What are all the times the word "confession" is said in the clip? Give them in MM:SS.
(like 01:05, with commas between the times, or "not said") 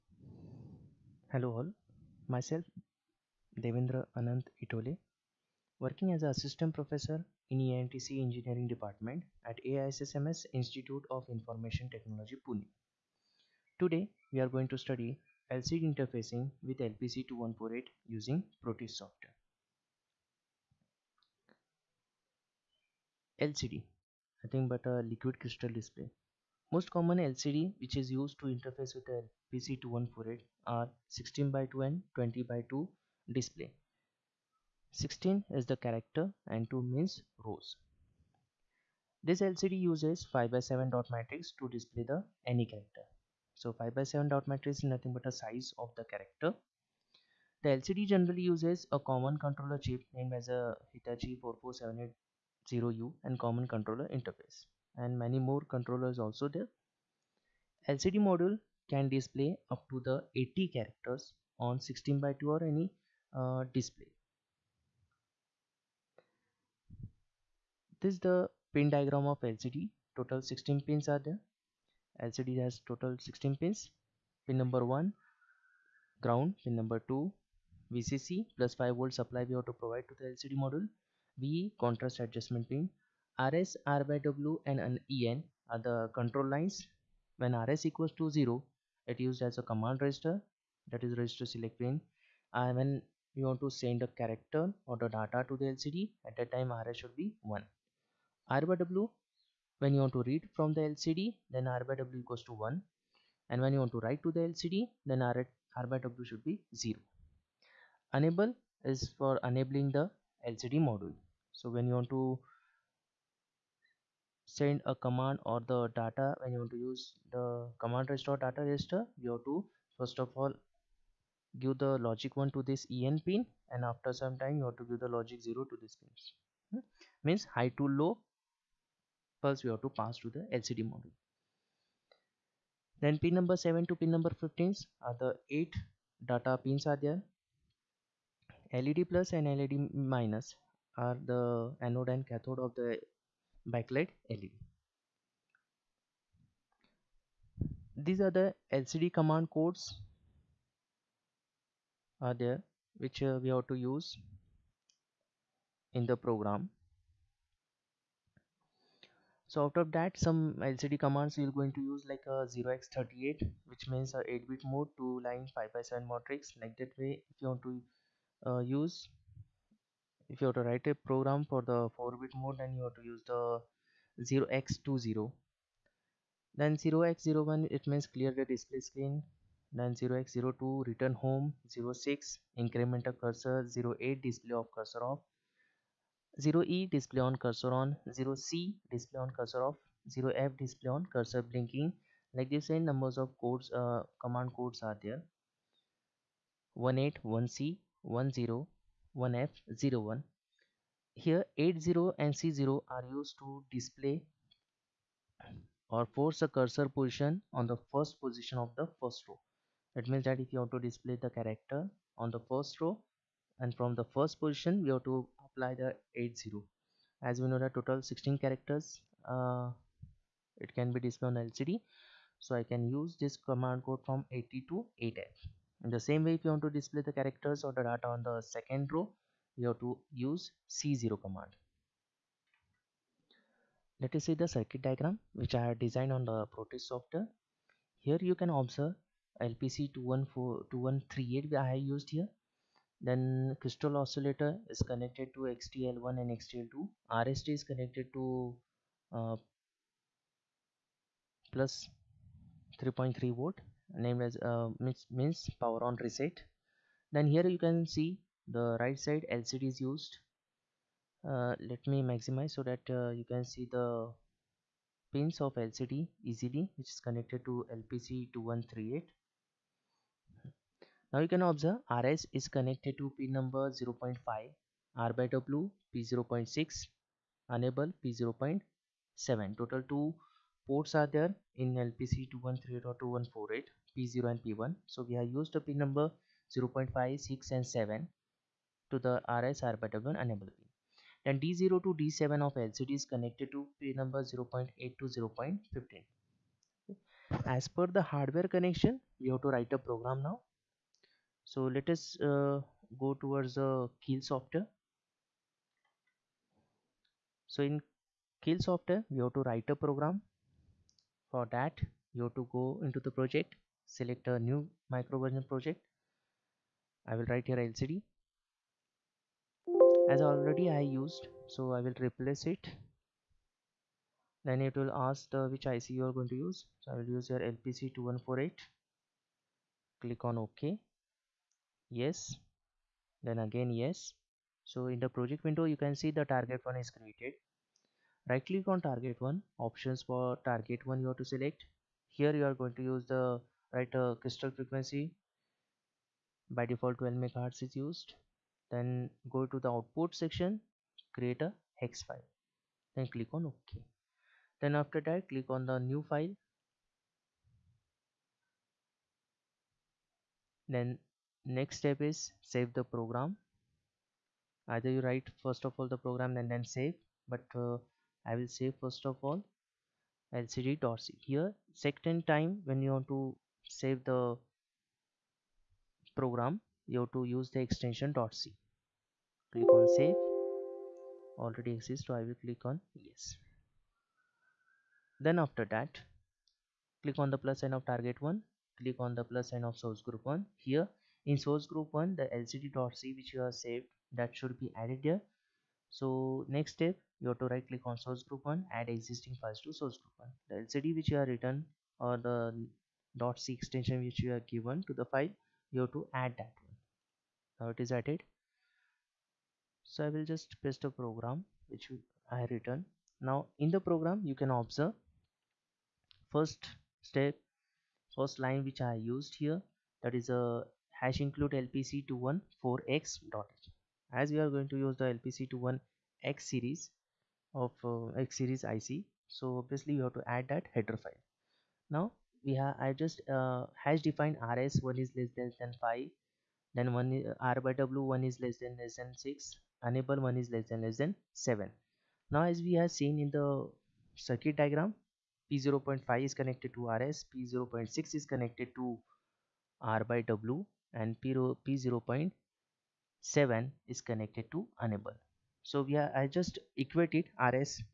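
not said.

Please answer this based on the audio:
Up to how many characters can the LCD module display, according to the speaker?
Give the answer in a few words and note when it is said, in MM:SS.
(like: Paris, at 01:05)
80, at 01:00.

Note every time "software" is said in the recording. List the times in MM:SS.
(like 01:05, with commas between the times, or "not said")
00:18, 03:56, 05:04, 05:08.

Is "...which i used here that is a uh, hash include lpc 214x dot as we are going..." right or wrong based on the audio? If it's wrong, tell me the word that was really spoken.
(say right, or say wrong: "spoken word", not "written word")
right.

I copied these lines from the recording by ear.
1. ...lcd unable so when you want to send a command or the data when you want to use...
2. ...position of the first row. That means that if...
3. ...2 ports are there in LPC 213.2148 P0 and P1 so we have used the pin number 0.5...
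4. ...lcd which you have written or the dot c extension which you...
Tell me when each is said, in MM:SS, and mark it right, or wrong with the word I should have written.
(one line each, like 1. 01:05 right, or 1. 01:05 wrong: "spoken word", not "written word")
1. 01:50 wrong: "module", not "unable"
2. 03:28 right
3. 04:39 right
4. 06:40 right.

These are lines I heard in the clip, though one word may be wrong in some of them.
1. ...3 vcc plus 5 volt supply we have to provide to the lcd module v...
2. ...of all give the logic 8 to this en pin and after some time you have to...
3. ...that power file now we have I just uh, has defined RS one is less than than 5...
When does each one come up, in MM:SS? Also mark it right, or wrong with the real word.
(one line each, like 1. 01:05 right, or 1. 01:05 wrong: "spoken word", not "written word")
1. 01:17 wrong: "2", not "3"
2. 02:00 wrong: "1", not "8"
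3. 07:10 wrong: "header", not "power".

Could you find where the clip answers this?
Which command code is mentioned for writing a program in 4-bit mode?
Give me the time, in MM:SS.
02:54.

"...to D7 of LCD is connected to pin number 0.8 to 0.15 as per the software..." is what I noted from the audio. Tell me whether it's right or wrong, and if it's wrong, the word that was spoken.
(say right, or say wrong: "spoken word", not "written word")
wrong: "hardware", not "software".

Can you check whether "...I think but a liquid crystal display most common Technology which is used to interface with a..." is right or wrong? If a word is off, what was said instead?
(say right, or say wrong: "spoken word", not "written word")
wrong: "LCD", not "Technology".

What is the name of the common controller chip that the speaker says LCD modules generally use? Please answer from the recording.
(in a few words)
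Hitachi 44780U.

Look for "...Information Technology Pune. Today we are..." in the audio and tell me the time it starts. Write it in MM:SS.
00:11.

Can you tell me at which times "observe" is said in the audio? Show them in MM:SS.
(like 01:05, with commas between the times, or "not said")
03:58, 04:31, 06:54.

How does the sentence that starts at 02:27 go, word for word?
These are the LCD command codes are there which uh, we have to use in the program.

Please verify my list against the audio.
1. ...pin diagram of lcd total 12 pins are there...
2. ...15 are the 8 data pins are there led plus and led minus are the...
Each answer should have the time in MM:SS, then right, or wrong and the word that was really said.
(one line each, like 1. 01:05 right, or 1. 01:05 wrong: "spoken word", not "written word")
1. 01:08 wrong: "16", not "12"
2. 02:14 right.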